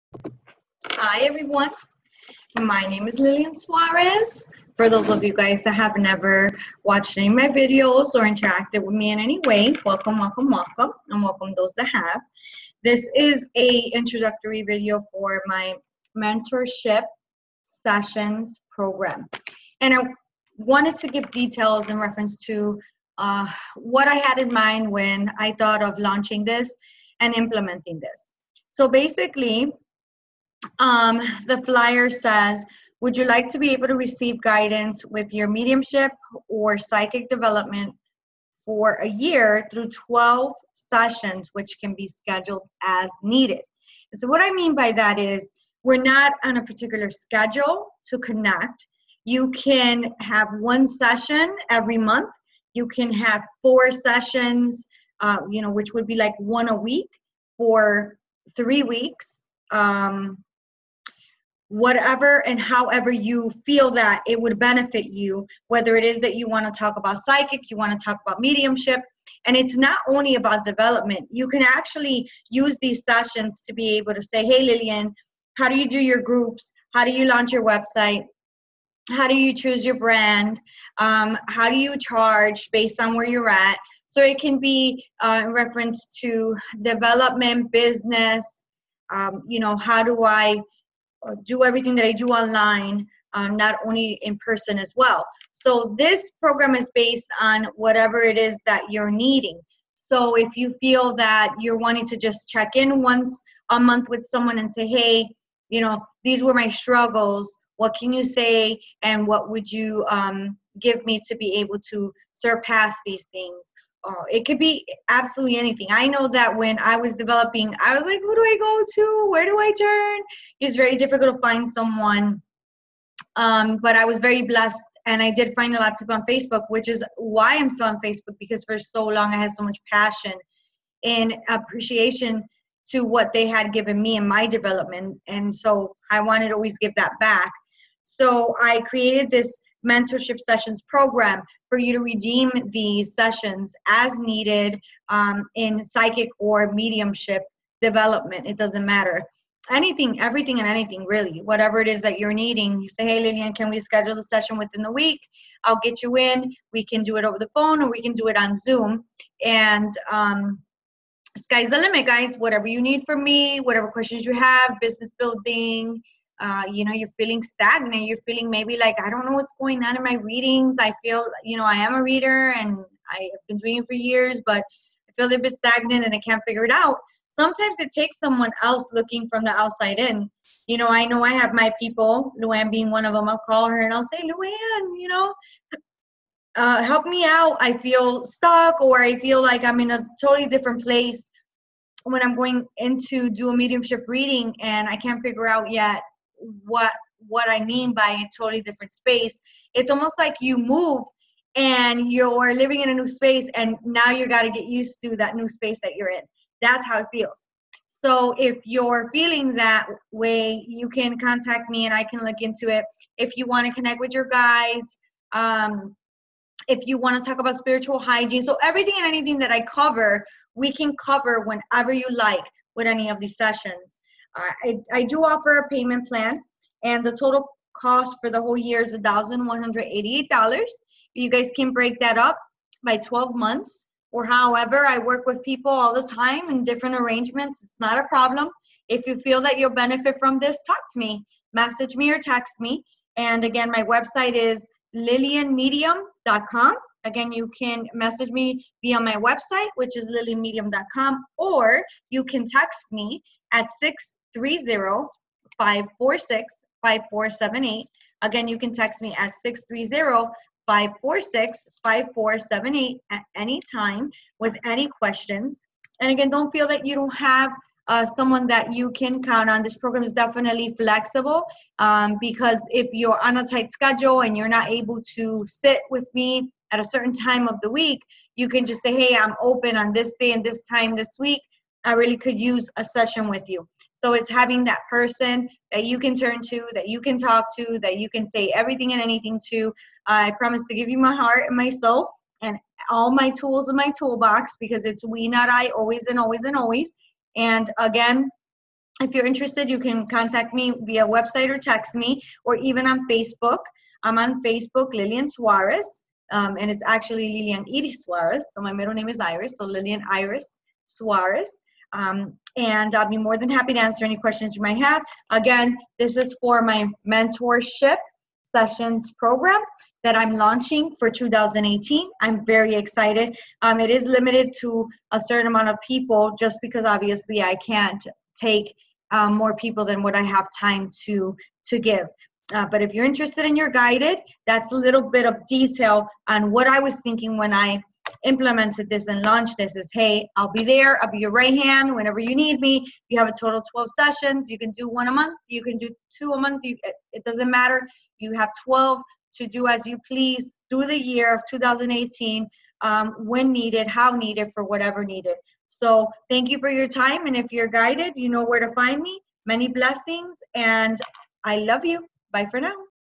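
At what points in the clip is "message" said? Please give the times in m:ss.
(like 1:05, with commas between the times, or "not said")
4:01, 4:07.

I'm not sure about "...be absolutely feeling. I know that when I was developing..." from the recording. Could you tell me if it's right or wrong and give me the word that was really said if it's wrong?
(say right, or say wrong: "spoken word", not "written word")
wrong: "anything", not "feeling".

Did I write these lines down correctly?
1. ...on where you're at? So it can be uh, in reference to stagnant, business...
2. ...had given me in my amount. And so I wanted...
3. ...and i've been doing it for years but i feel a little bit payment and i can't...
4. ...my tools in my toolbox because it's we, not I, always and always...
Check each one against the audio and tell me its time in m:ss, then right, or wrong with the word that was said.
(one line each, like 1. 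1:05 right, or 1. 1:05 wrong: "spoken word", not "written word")
1. 1:22 wrong: "development", not "stagnant"
2. 2:13 wrong: "development", not "amount"
3. 2:52 wrong: "stagnant", not "payment"
4. 4:53 right.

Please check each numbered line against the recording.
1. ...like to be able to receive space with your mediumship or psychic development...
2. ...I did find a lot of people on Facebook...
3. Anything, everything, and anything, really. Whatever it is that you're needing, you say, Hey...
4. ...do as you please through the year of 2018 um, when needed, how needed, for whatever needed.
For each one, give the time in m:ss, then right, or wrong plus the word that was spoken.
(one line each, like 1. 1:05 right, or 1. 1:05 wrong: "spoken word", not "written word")
1. 0:33 wrong: "guidance", not "space"
2. 2:05 right
3. 2:29 right
4. 5:49 right.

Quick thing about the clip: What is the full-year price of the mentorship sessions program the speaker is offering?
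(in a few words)
$1,188.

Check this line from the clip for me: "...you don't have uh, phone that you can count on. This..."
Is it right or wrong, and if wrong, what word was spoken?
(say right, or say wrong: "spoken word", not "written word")
wrong: "someone", not "phone".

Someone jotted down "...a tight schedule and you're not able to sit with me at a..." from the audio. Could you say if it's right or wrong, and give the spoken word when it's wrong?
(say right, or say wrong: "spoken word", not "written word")
right.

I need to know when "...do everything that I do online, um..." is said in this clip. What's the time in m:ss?
1:31.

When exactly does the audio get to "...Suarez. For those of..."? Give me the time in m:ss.
0:03.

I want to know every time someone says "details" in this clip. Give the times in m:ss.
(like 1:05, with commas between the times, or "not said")
0:21, 5:35.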